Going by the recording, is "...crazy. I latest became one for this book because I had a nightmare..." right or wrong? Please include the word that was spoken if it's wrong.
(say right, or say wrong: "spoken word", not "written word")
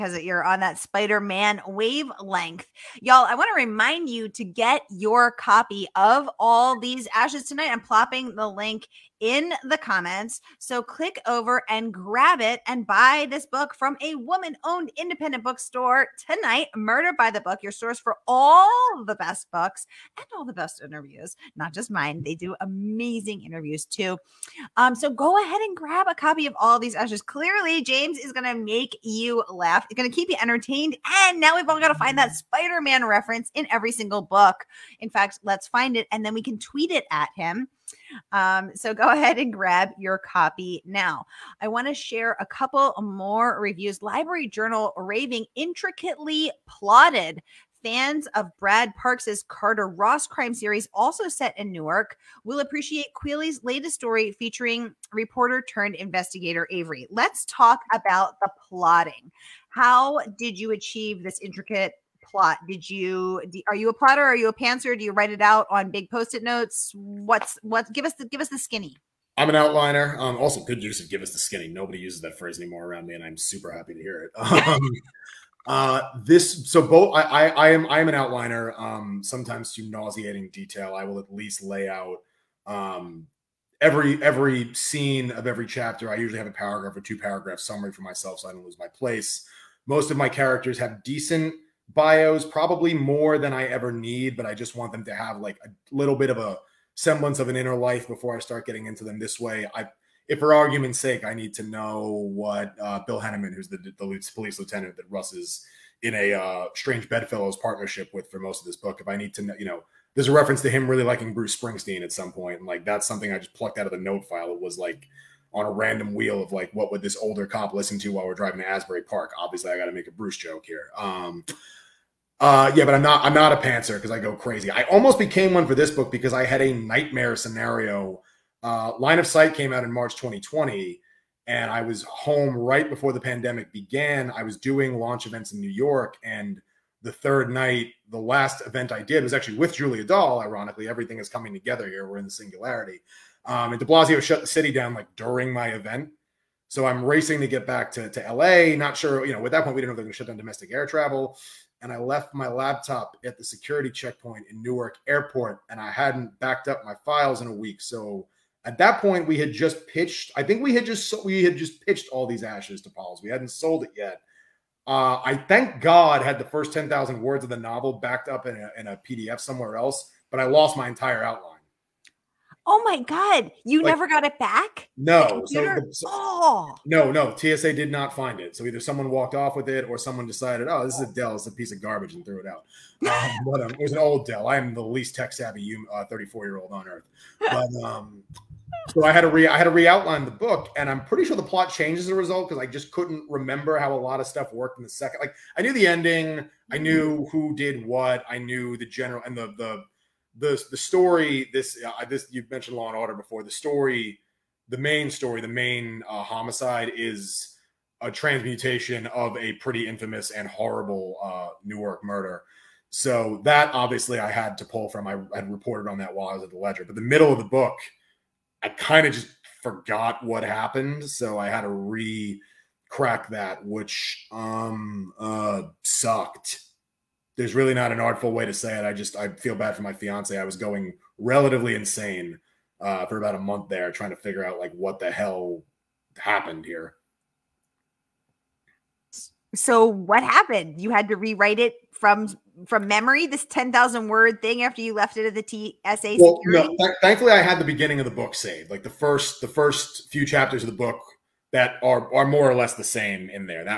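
wrong: "almost", not "latest".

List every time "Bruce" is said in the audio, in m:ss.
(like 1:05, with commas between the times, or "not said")
1:51, 2:00.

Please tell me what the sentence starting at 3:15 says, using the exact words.
Like I knew the ending, I mm-hmm.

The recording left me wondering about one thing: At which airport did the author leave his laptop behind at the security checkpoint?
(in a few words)
Newark Airport.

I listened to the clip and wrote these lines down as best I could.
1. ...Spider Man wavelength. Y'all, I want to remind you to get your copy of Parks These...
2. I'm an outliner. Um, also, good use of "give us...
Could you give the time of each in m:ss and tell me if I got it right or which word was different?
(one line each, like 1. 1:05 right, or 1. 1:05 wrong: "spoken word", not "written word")
1. 0:00 wrong: "All", not "Parks"
2. 1:09 right.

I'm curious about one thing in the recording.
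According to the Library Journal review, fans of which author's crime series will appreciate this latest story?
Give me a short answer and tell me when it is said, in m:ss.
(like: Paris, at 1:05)
Brad Parks, at 0:48.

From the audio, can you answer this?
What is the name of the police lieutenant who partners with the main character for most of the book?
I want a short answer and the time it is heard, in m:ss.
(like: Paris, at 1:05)
Bill Henneman, at 1:43.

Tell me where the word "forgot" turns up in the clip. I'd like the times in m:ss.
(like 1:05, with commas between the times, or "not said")
3:39.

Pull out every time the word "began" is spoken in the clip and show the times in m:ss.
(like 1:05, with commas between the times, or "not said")
2:13.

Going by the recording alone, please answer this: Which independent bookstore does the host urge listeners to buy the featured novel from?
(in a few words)
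Murder by the Book.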